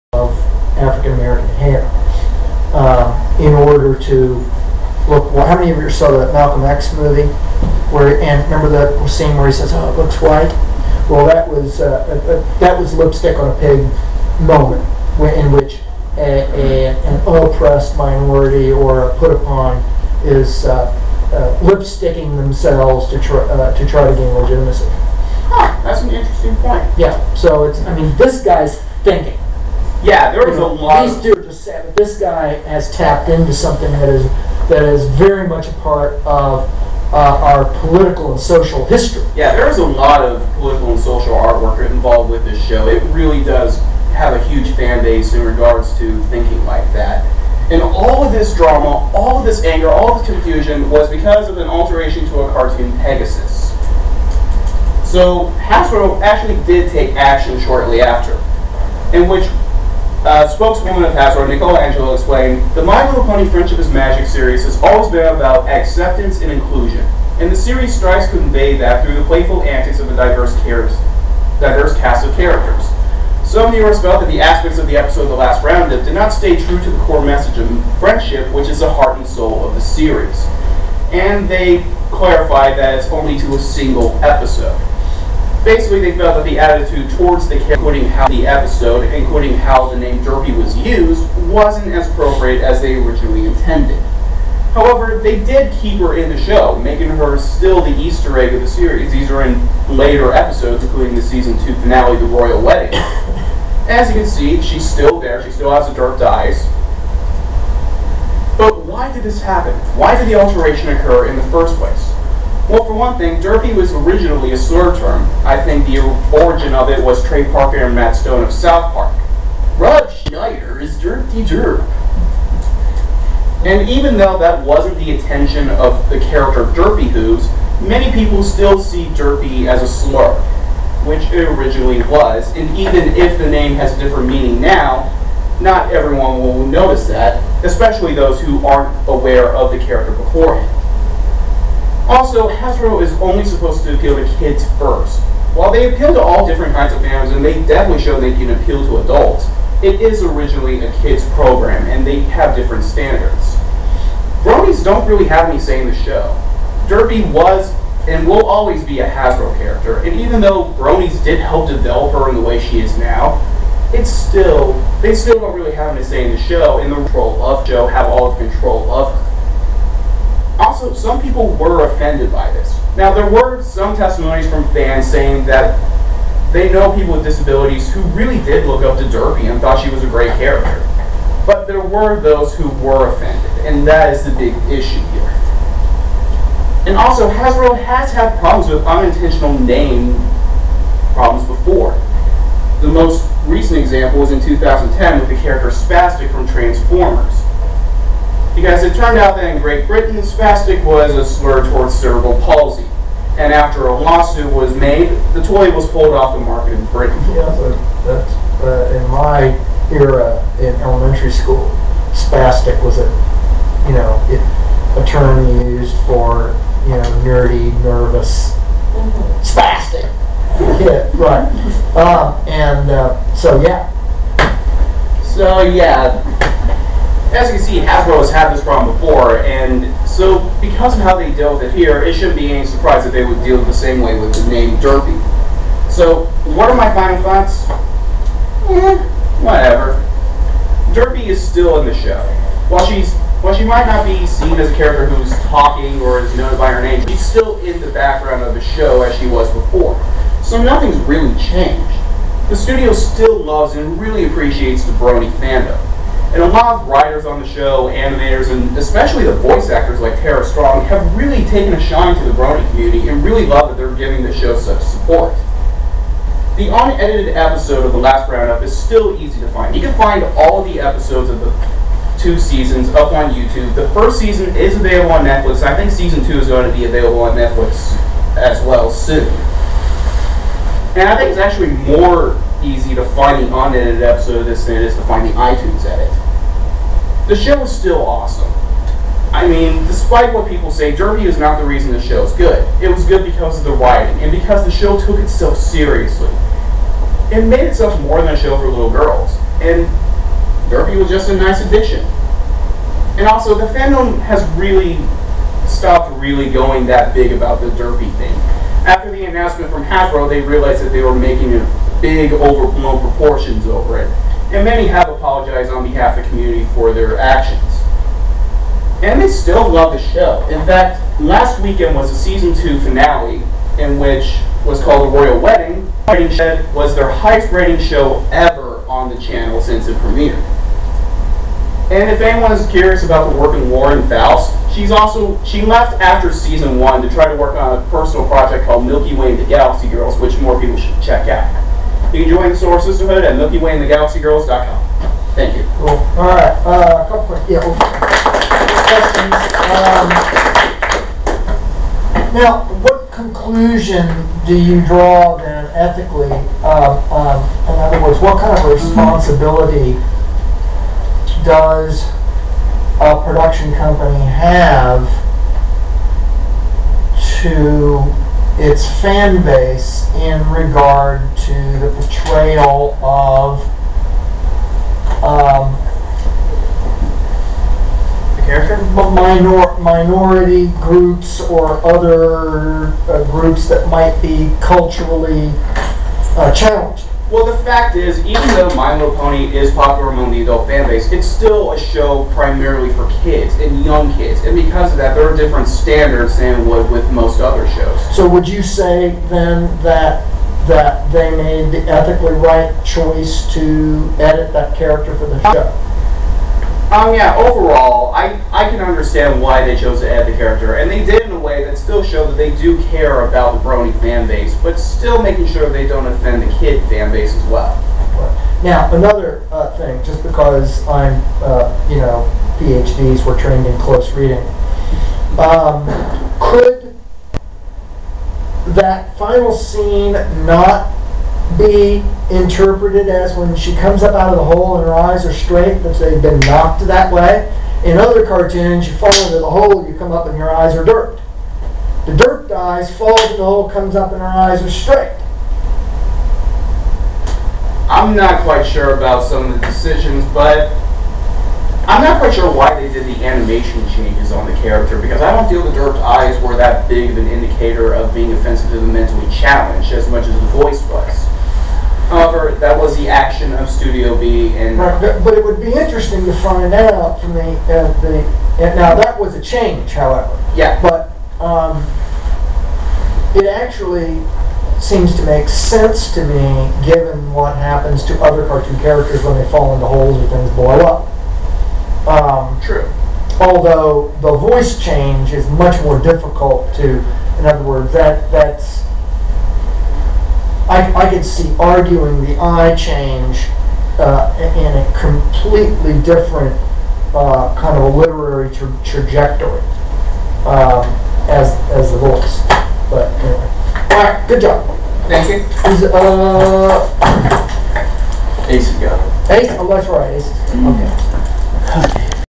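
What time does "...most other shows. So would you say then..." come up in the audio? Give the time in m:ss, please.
6:37.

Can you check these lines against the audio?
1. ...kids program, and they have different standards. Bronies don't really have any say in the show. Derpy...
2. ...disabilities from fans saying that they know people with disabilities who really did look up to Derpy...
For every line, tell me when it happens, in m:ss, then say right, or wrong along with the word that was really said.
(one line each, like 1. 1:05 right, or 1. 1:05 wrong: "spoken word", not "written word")
1. 2:31 right
2. 2:53 wrong: "testimonies", not "disabilities".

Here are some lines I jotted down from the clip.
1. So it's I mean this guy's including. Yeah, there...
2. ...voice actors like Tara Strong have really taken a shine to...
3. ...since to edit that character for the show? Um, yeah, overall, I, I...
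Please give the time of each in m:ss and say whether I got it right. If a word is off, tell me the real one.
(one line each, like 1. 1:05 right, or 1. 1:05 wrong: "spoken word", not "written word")
1. 0:27 wrong: "thinking", not "including"
2. 4:19 right
3. 6:42 wrong: "choice", not "since".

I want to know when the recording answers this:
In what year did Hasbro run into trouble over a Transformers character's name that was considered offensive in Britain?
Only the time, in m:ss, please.
3:14.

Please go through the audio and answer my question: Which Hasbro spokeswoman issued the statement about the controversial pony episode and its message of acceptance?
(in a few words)
Nicola Angelo.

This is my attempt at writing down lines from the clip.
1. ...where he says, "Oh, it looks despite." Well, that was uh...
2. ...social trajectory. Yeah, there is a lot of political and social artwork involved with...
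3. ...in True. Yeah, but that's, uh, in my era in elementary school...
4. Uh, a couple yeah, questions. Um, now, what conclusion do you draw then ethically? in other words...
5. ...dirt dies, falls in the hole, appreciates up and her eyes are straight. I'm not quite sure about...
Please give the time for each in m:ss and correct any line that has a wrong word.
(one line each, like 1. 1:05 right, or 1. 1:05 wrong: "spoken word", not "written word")
1. 0:09 wrong: "white", not "despite"
2. 0:38 wrong: "history", not "trajectory"
3. 3:26 wrong: "Britain", not "True"
4. 5:46 right
5. 7:22 wrong: "comes", not "appreciates".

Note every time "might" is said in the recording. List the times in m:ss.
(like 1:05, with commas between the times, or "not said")
4:03, 6:23.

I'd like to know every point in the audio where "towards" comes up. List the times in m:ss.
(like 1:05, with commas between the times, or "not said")
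1:27, 3:21.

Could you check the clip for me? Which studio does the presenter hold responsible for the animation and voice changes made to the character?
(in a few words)
Studio B.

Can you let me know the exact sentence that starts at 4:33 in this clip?
The first season is available on Netflix.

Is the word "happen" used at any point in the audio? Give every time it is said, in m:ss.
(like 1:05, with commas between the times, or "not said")
1:49, 7:57.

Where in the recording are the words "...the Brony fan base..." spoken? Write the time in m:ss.
6:53.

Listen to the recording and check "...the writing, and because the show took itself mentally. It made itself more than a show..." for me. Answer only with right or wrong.
wrong.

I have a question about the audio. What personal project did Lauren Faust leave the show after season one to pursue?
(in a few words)
Milky Way and the Galaxy Girls.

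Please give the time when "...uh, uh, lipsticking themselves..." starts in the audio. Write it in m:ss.
0:20.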